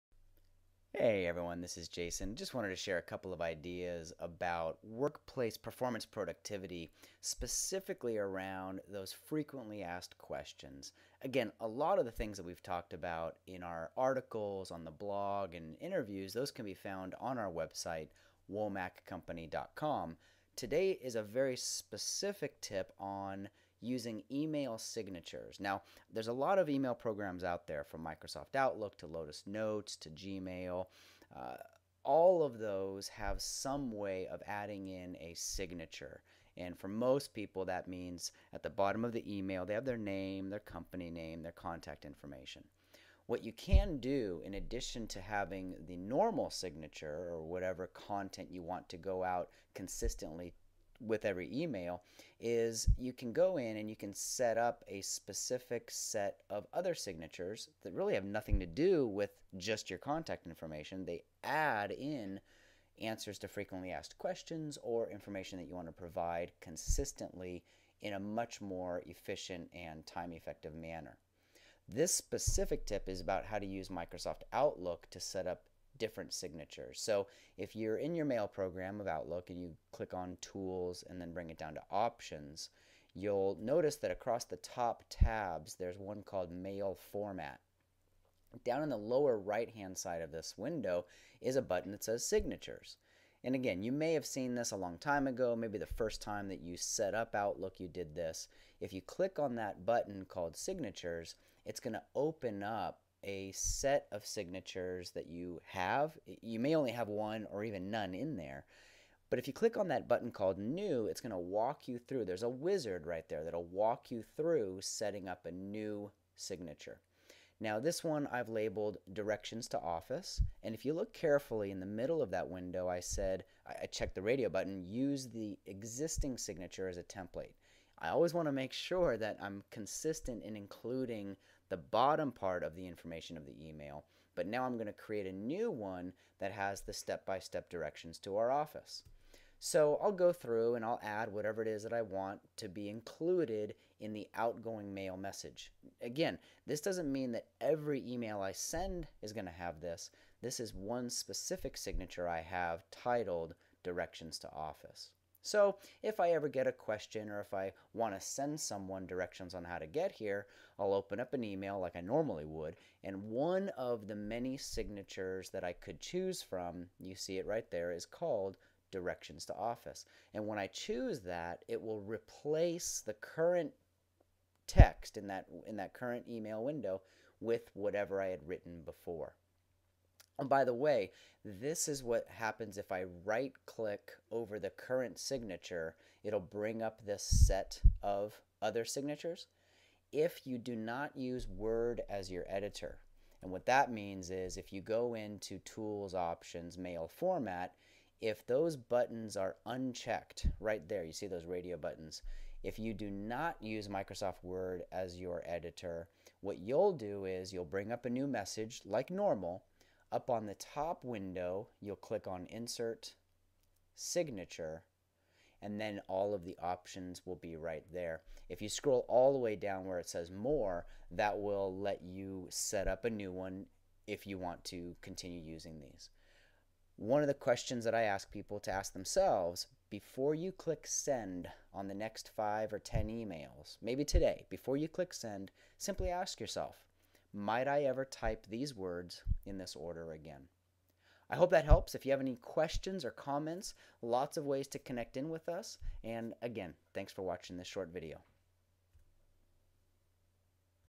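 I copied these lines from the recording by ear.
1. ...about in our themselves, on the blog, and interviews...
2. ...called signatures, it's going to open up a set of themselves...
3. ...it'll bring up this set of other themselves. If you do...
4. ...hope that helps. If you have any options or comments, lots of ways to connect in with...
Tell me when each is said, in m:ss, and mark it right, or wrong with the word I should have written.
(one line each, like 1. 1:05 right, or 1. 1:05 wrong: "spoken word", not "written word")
1. 0:12 wrong: "articles", not "themselves"
2. 1:40 wrong: "signatures", not "themselves"
3. 3:06 wrong: "signatures", not "themselves"
4. 4:01 wrong: "questions", not "options".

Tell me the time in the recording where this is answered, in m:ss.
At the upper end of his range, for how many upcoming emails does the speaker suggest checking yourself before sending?
3:52.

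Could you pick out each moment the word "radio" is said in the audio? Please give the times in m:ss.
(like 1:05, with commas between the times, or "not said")
2:04, 3:21.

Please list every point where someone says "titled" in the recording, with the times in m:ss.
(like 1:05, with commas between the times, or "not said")
2:32.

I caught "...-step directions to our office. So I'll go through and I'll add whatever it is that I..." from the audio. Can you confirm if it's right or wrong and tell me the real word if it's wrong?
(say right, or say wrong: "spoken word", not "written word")
right.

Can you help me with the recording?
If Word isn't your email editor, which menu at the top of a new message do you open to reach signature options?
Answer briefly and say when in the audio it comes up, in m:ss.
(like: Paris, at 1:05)
Insert, at 3:32.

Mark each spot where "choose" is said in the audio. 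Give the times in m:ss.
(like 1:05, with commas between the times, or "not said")
2:45, 2:50.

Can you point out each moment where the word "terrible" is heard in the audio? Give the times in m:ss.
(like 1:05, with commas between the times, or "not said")
not said.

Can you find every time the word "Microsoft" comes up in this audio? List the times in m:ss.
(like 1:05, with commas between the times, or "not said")
0:28, 1:13, 3:23.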